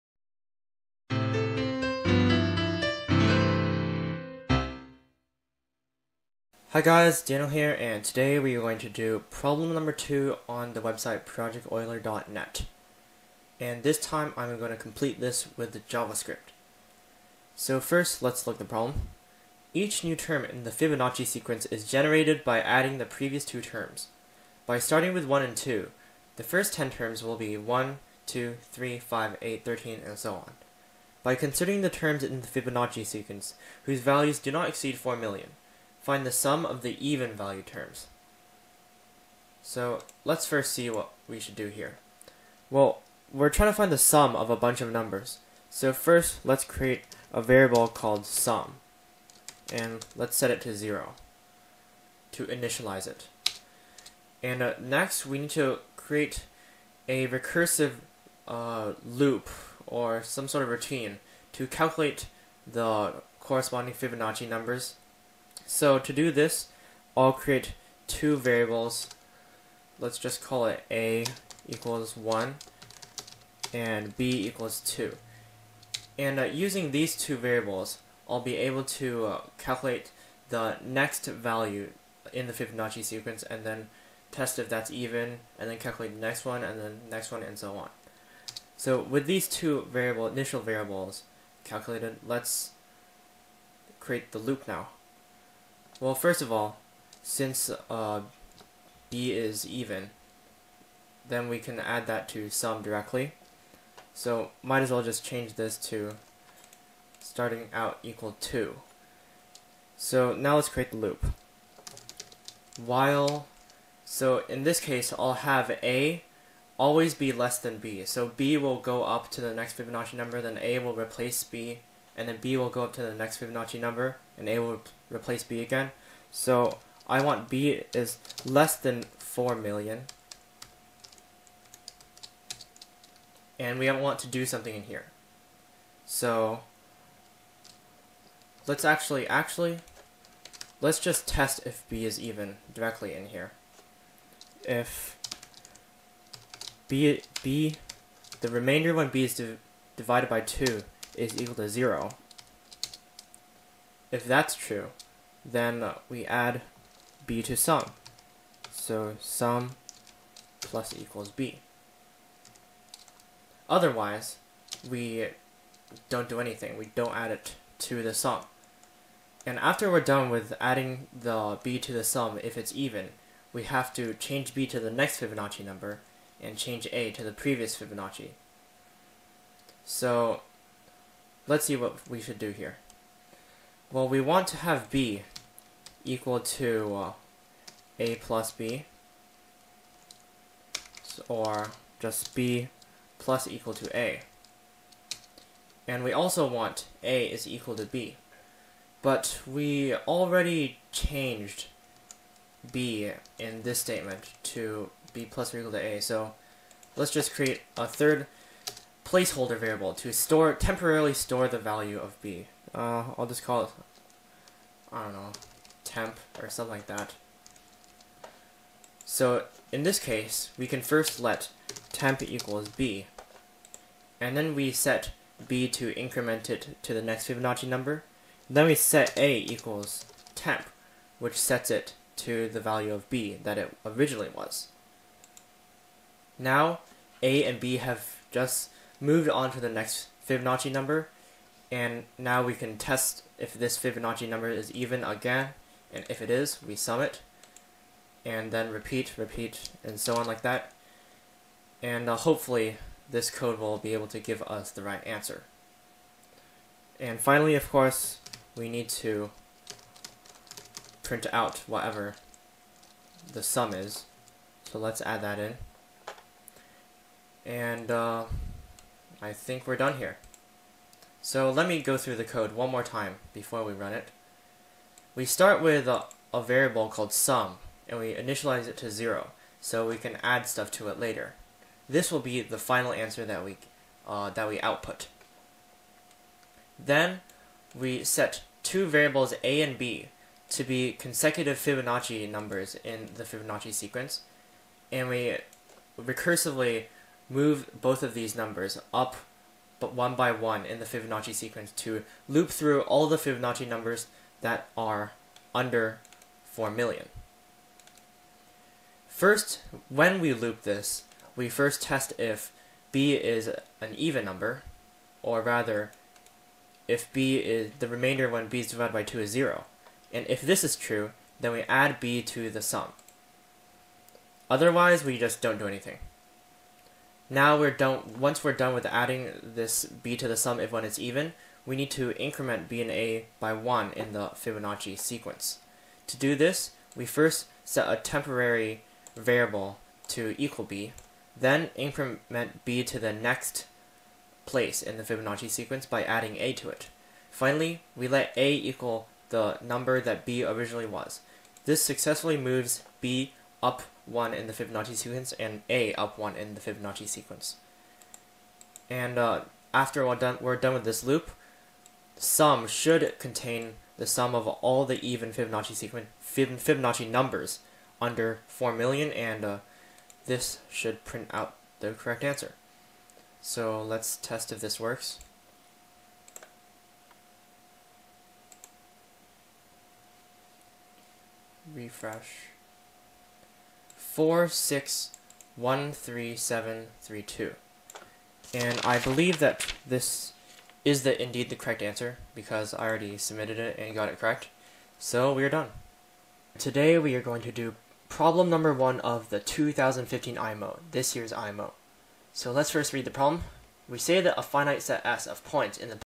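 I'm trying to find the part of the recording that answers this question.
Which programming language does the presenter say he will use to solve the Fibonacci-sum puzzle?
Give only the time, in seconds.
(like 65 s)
15 s.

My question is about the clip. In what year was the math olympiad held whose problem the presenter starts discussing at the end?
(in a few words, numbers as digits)
2015.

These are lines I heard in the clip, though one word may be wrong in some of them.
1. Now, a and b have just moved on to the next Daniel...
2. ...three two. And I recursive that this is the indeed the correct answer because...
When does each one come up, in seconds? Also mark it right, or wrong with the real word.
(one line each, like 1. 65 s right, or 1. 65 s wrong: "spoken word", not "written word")
1. 236 s wrong: "Fibonacci", not "Daniel"
2. 387 s wrong: "believe", not "recursive".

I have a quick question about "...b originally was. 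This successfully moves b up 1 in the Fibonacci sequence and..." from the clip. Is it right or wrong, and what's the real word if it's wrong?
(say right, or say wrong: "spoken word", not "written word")
right.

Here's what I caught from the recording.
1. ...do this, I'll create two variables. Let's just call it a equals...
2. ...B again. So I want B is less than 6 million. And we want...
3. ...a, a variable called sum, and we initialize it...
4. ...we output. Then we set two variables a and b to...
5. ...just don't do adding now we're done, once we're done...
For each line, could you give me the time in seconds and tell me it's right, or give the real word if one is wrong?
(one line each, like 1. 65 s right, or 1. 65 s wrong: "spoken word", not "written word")
1. 66 s right
2. 125 s wrong: "4", not "6"
3. 275 s right
4. 284 s right
5. 325 s wrong: "anything", not "adding".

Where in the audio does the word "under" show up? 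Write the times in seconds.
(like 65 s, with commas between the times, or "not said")
305 s, 368 s.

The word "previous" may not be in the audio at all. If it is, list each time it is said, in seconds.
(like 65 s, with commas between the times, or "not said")
23 s, 177 s.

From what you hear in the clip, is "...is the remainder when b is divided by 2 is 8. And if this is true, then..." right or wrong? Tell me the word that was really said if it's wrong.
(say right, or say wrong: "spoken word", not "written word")
wrong: "0", not "8".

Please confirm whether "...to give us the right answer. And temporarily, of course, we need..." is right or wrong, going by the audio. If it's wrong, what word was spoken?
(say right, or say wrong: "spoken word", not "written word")
wrong: "finally", not "temporarily".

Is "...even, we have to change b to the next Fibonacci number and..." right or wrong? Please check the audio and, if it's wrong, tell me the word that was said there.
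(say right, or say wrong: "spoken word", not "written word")
right.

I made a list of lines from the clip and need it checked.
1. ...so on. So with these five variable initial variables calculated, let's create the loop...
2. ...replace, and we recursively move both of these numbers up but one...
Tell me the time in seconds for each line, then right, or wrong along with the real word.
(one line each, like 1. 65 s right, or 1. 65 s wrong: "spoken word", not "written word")
1. 87 s wrong: "two", not "five"
2. 293 s wrong: "sequence", not "replace".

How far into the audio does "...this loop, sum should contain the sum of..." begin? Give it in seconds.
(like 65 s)
360 s.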